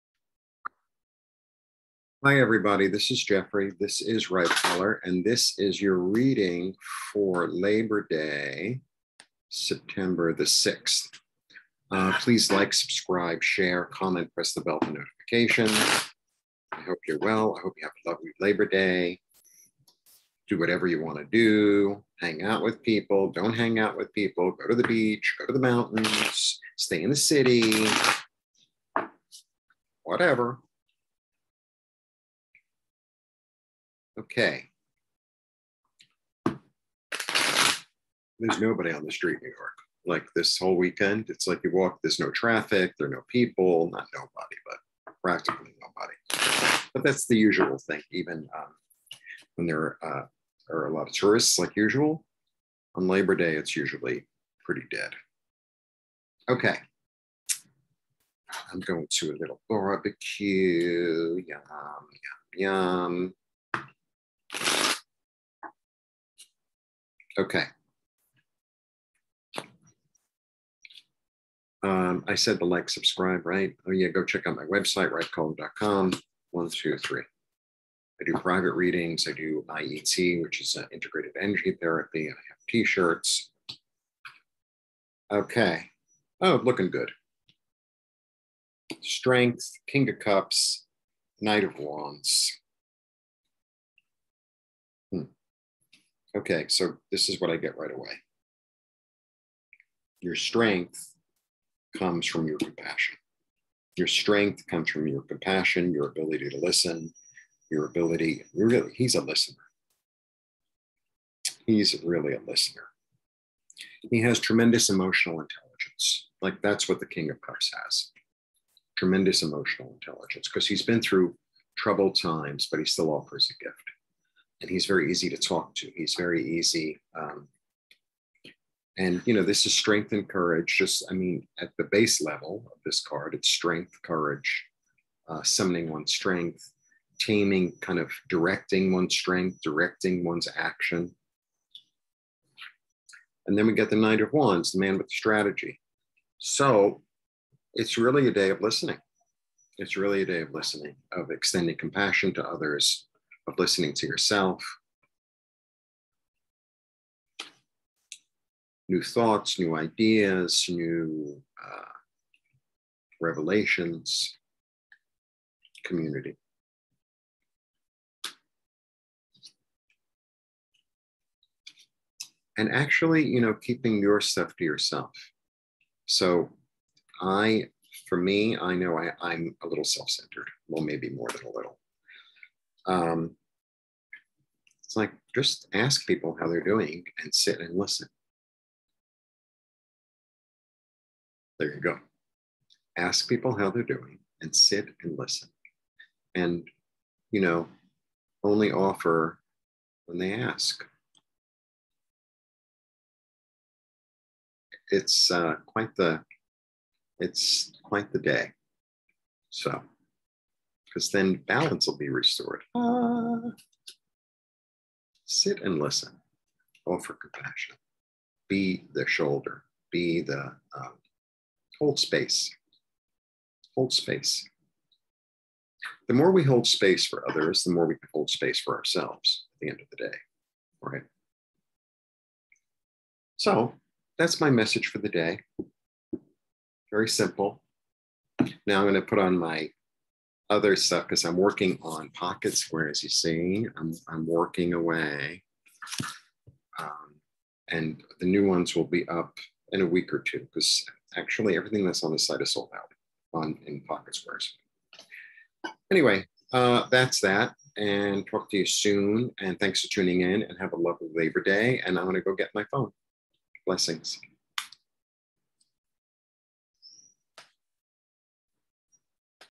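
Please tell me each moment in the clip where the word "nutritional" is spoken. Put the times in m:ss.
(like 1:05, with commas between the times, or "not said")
not said.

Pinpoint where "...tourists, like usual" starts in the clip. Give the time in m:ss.
0:51.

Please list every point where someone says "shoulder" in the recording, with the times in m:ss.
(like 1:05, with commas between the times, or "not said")
3:39.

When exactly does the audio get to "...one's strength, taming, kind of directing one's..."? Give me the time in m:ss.
2:15.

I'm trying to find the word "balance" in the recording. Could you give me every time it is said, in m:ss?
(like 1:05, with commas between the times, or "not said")
3:31.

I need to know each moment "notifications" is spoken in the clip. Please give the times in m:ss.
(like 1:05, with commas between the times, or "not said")
0:14.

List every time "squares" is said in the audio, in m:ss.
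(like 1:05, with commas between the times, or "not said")
4:02, 4:14.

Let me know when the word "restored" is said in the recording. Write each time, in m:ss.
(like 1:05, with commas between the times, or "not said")
3:32.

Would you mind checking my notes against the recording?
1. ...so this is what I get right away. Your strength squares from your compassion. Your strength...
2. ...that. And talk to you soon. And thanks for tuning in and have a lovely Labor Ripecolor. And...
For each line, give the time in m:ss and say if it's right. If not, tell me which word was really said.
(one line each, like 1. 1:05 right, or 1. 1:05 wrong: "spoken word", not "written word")
1. 1:36 wrong: "comes", not "squares"
2. 4:17 wrong: "Day", not "Ripecolor".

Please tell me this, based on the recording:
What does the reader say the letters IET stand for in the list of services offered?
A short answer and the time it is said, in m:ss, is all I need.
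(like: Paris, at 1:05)
Integrated energy therapy, at 1:20.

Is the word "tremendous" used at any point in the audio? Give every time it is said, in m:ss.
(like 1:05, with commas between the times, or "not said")
1:54, 1:58.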